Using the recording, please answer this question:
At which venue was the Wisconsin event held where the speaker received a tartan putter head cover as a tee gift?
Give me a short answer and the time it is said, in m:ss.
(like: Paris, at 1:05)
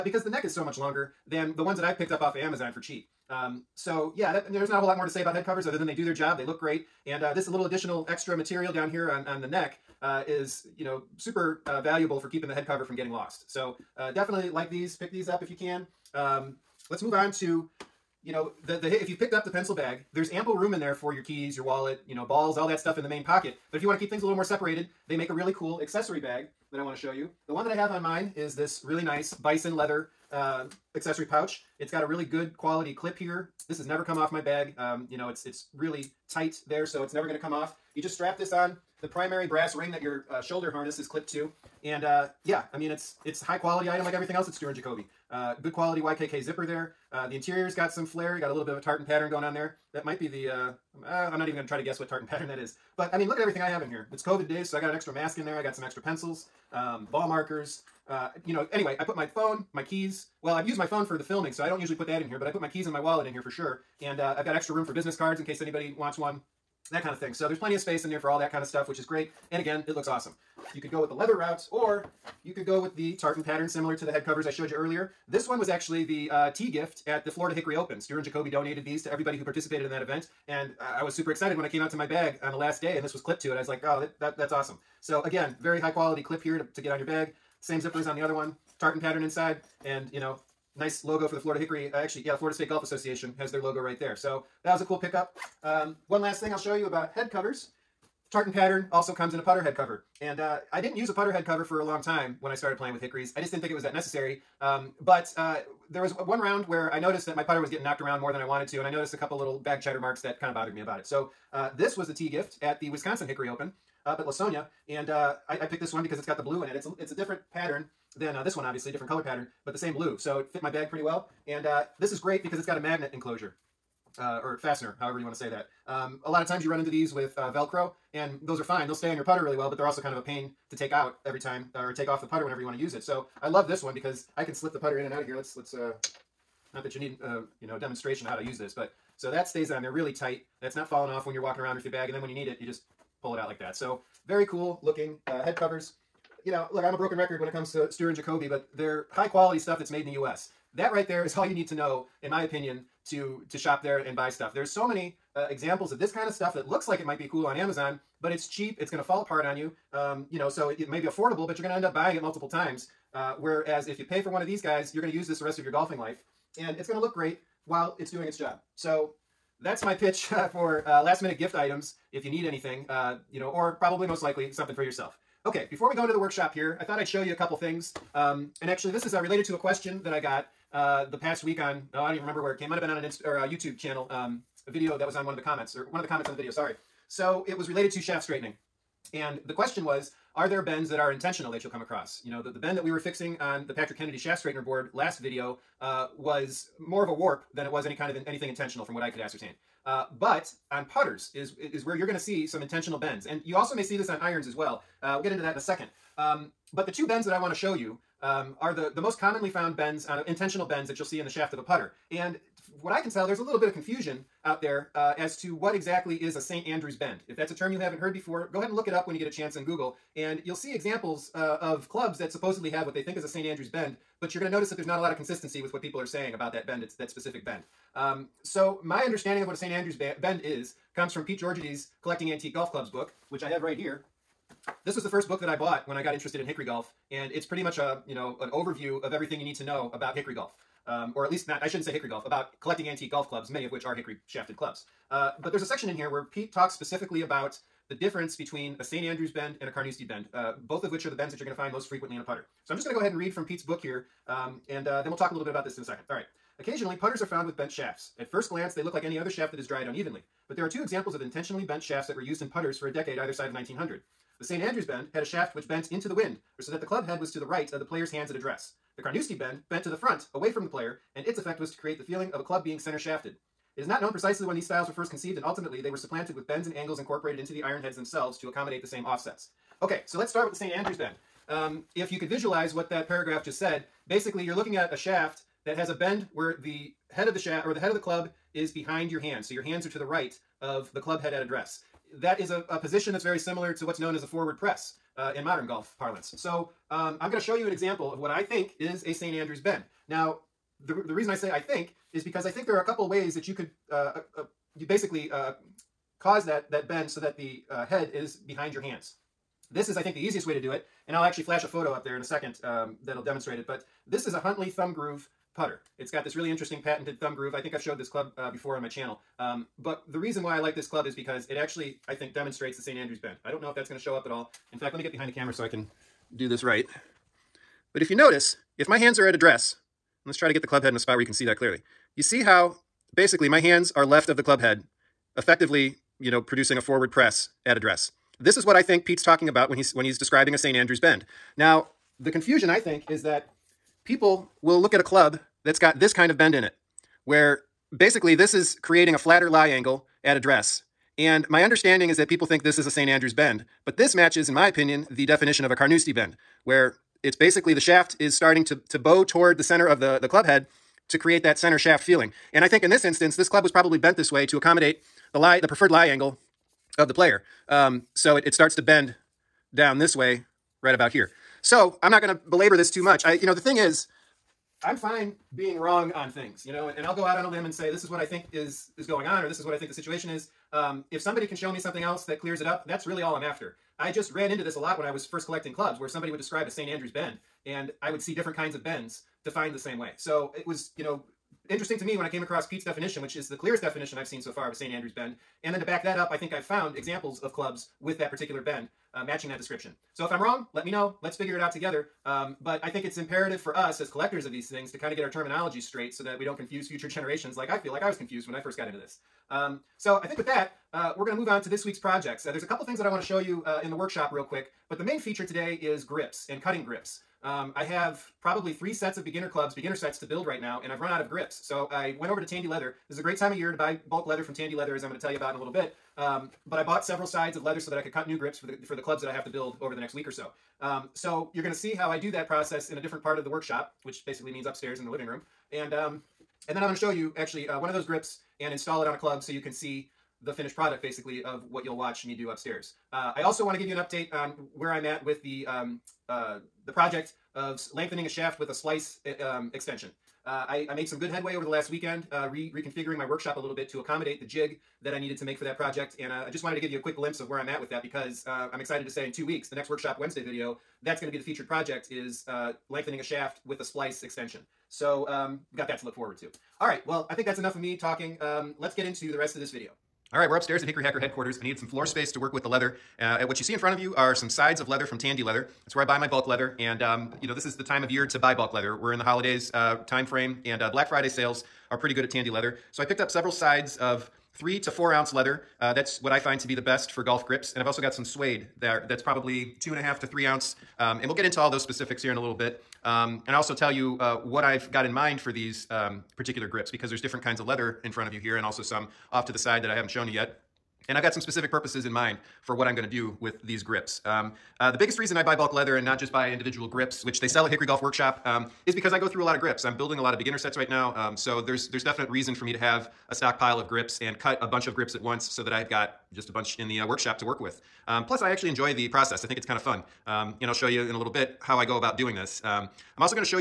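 Lawsonia, at 1:54.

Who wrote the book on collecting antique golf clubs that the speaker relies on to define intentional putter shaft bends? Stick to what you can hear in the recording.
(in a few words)
Pete Georgiady.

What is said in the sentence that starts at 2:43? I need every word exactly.
Uh, whereas if you pay for one of these guys, you're going to use this the rest of your golfing life.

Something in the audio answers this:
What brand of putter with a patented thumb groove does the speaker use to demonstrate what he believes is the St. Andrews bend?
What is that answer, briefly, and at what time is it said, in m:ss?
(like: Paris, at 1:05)
Huntley, at 5:14.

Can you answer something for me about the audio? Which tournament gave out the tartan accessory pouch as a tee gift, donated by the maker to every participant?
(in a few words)
Florida Hickory Open.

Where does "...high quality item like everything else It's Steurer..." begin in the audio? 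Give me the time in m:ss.
0:43.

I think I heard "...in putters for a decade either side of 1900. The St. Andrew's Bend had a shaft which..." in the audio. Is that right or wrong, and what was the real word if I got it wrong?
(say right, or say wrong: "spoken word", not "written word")
right.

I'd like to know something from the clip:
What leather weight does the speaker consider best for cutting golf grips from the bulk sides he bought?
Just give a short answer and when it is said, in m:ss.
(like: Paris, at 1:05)
3 to 4 ounce, at 8:04.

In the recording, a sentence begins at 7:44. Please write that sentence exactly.
So um, we've got that to look forward to.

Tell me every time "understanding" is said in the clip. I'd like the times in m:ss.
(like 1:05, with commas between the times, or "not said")
3:49, 5:51.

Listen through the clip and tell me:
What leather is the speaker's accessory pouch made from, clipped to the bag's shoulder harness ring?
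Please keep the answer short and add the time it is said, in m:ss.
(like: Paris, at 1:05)
Bison leather, at 0:29.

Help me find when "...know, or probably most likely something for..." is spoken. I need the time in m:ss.
2:53.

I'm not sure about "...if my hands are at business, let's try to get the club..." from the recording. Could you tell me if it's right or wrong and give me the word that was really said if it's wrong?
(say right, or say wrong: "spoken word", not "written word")
wrong: "address", not "business".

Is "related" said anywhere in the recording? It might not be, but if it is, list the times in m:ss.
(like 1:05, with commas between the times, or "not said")
2:59, 3:07.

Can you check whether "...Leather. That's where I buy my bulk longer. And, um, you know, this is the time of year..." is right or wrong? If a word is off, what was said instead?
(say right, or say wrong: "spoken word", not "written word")
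wrong: "leather", not "longer".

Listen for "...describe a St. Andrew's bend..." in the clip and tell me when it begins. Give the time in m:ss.
6:26.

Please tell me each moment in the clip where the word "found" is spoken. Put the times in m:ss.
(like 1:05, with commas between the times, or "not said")
3:29, 4:17, 6:36.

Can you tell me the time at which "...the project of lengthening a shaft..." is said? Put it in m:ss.
7:26.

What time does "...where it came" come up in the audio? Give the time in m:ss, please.
3:02.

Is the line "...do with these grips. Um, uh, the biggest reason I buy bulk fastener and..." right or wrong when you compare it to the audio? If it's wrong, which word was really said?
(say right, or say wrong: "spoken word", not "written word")
wrong: "leather", not "fastener".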